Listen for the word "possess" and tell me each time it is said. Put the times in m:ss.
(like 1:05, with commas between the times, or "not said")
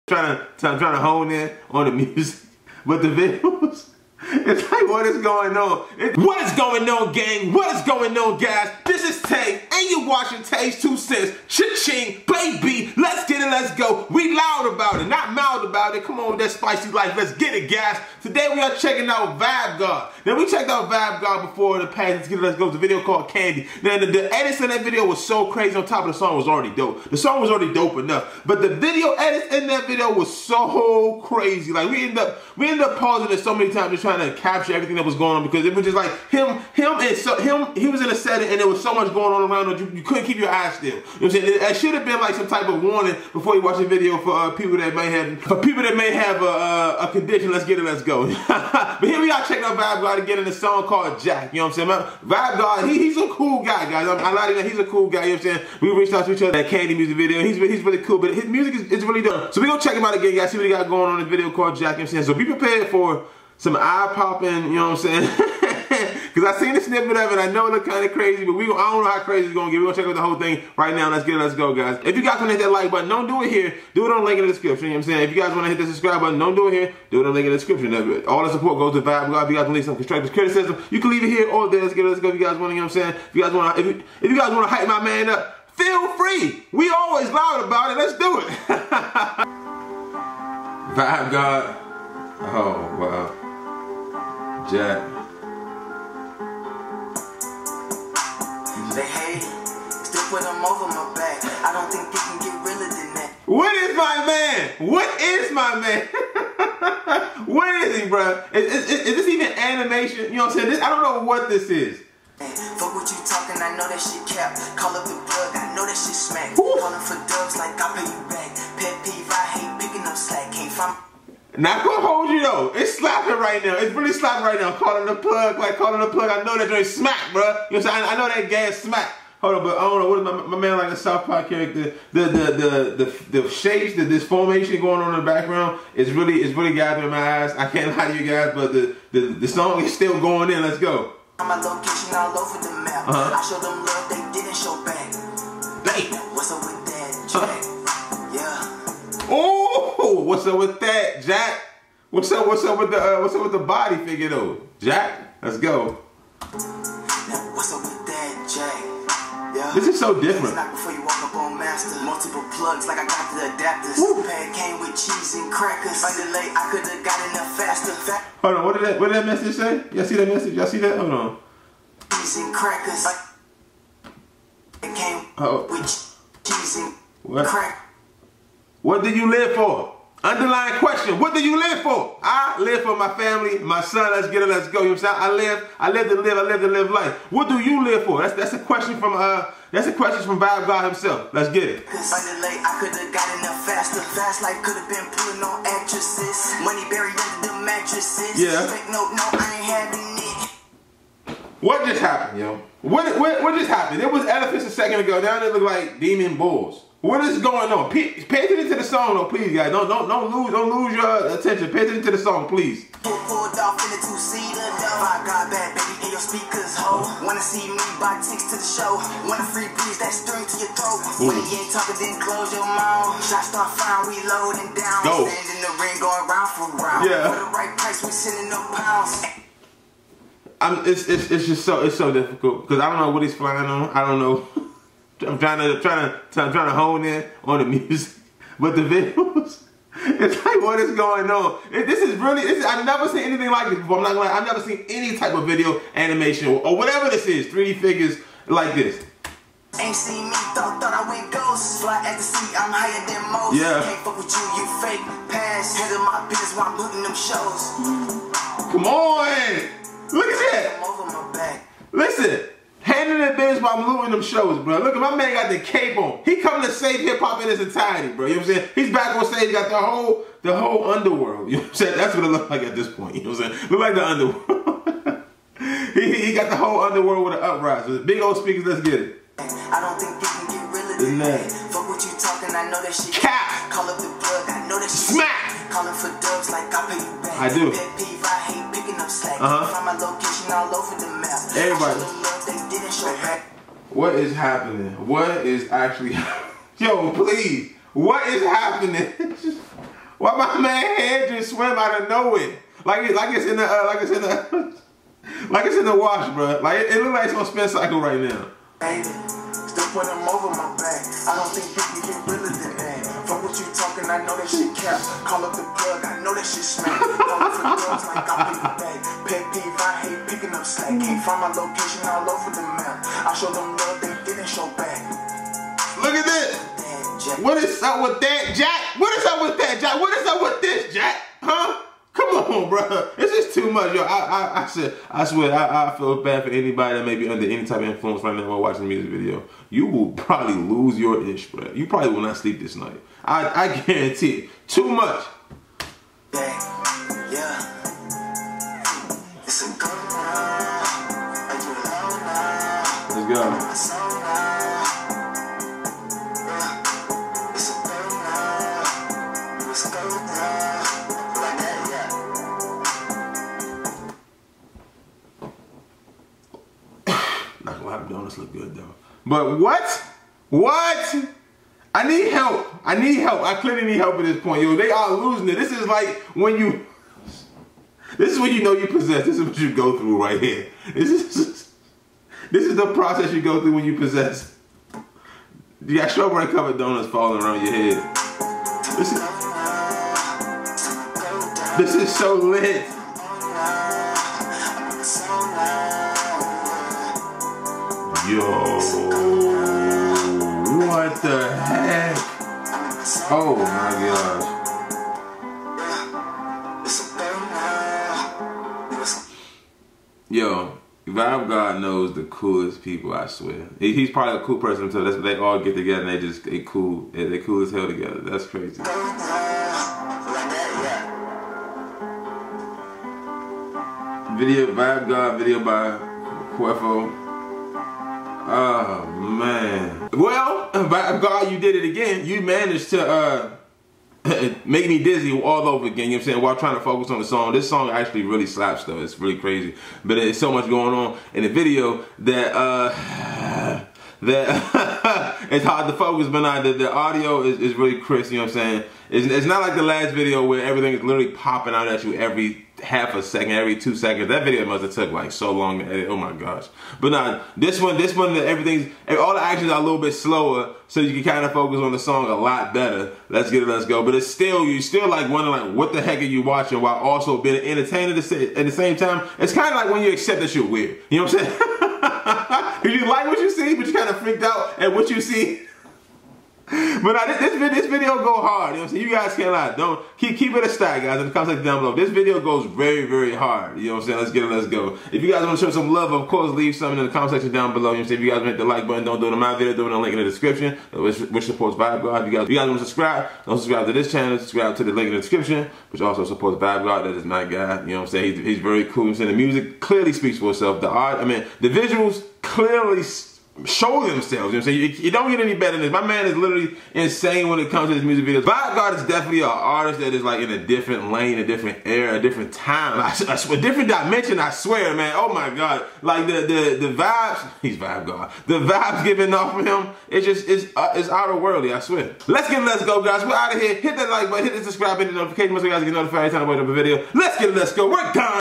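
6:18, 6:23.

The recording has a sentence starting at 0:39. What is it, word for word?
You, you couldn't keep your eyes still.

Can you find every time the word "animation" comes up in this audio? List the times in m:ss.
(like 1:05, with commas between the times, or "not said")
1:49, 4:05.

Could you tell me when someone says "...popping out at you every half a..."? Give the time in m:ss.
7:31.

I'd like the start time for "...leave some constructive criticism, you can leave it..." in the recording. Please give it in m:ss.
1:19.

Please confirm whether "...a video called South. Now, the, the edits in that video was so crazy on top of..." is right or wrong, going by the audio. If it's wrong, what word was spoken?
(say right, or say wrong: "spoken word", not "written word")
wrong: "Candy", not "South".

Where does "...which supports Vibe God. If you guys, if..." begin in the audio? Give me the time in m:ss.
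8:11.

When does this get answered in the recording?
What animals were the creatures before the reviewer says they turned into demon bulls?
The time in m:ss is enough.
3:24.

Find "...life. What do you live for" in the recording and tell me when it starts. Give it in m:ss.
3:06.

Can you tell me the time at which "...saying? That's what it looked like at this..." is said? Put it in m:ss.
4:31.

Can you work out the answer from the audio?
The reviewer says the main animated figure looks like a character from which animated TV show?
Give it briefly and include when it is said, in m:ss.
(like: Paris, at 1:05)
South Park, at 2:10.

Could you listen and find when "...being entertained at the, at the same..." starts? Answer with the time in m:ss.
7:47.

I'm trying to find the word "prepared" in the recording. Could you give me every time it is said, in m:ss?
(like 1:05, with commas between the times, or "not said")
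1:02.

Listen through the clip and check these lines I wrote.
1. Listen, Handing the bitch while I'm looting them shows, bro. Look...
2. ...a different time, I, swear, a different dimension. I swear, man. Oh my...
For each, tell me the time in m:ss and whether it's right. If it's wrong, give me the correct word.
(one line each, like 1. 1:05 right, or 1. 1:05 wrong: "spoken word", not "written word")
1. 4:21 right
2. 8:32 right.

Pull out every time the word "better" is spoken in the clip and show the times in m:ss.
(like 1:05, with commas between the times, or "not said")
7:42, 8:25.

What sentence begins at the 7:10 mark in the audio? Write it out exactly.
Well, Vibe God, you did it again.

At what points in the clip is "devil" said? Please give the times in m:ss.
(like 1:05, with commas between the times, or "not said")
not said.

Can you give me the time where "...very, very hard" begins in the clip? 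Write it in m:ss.
8:02.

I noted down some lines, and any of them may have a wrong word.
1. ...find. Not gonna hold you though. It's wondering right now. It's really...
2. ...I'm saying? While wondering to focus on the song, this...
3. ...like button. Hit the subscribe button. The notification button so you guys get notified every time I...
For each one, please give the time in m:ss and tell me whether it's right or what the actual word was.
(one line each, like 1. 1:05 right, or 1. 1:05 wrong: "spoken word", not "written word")
1. 2:00 wrong: "slapping", not "wondering"
2. 7:16 wrong: "trying", not "wondering"
3. 8:44 right.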